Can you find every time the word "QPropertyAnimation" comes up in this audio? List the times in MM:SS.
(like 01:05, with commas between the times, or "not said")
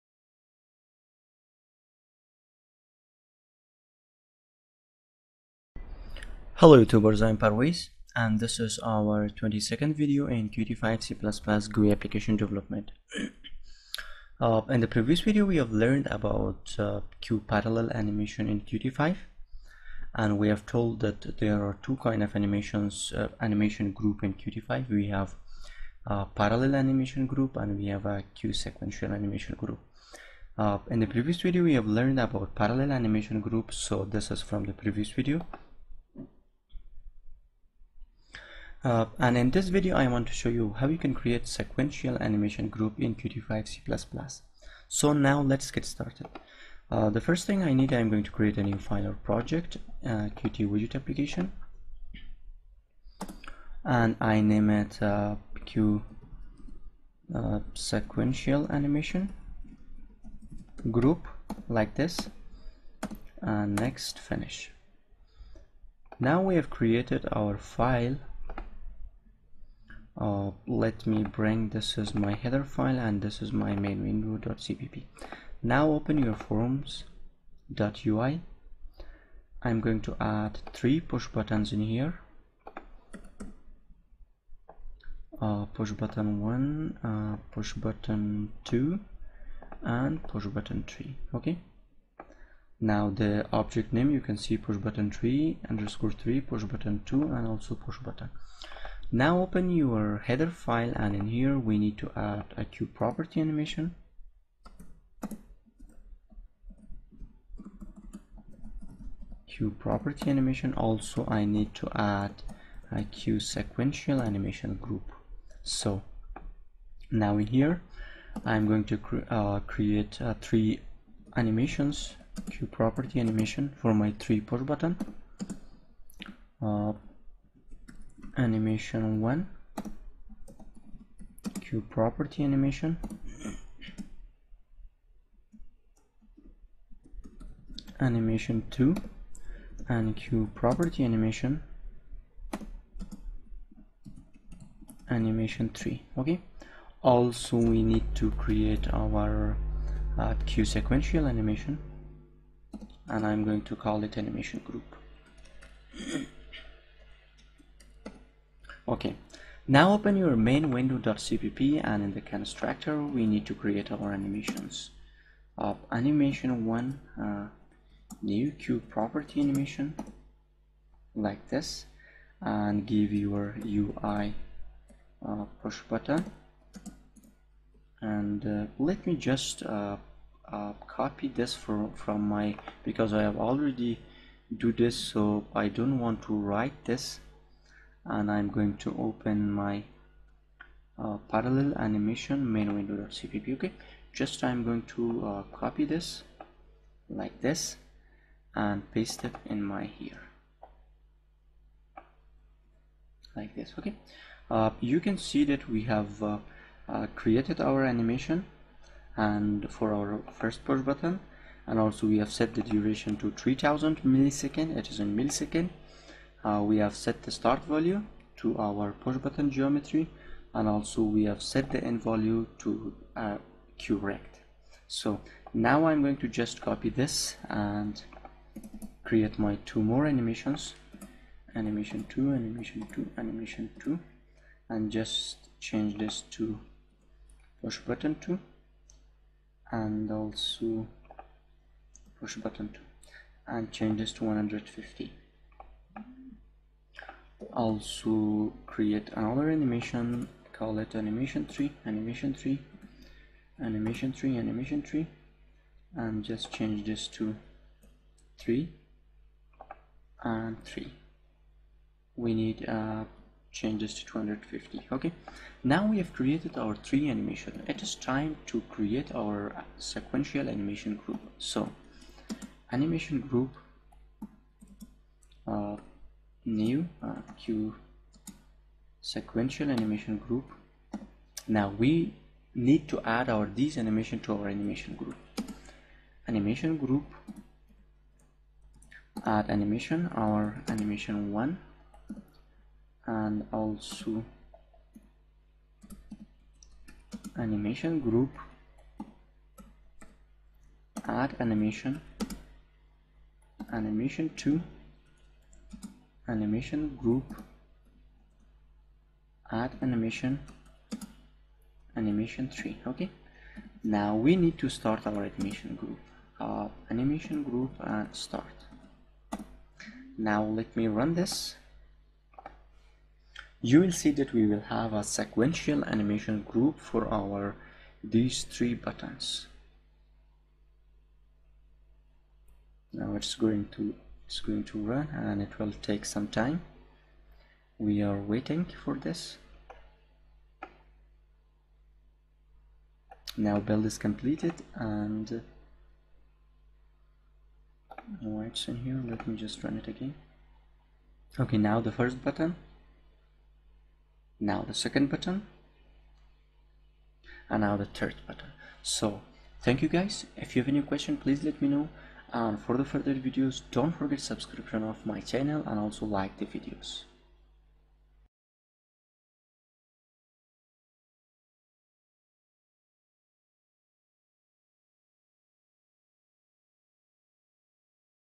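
01:42, 02:02, 02:11, 02:20, 02:48.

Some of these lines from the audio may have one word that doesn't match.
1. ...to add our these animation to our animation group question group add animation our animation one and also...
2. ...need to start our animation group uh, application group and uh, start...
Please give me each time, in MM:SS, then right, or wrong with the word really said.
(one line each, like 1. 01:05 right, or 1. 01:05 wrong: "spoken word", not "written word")
1. 04:42 wrong: "animation", not "question"
2. 05:14 wrong: "animation", not "application".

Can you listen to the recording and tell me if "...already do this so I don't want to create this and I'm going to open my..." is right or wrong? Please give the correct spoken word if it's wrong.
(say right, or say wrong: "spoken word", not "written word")
wrong: "write", not "create".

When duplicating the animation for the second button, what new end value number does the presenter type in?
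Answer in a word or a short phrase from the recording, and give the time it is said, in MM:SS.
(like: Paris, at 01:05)
150, at 04:04.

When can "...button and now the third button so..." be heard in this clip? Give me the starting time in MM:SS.
05:55.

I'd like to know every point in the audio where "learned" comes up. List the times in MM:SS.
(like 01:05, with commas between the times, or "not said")
00:15, 00:31.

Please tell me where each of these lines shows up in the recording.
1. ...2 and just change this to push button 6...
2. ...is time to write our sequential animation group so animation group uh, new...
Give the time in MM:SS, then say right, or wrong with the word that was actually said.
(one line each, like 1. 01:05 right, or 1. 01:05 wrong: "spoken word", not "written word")
1. 03:53 wrong: "2", not "6"
2. 04:27 wrong: "create", not "write".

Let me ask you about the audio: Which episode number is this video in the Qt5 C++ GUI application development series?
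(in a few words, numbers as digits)
22nd.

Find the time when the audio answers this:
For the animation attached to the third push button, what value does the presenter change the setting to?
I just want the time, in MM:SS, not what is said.
04:24.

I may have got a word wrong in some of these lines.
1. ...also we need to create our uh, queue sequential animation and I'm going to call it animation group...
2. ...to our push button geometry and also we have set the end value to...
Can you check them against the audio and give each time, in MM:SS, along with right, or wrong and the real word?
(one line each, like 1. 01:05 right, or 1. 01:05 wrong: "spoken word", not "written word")
1. 02:27 right
2. 03:38 right.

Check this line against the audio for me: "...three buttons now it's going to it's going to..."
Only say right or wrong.
right.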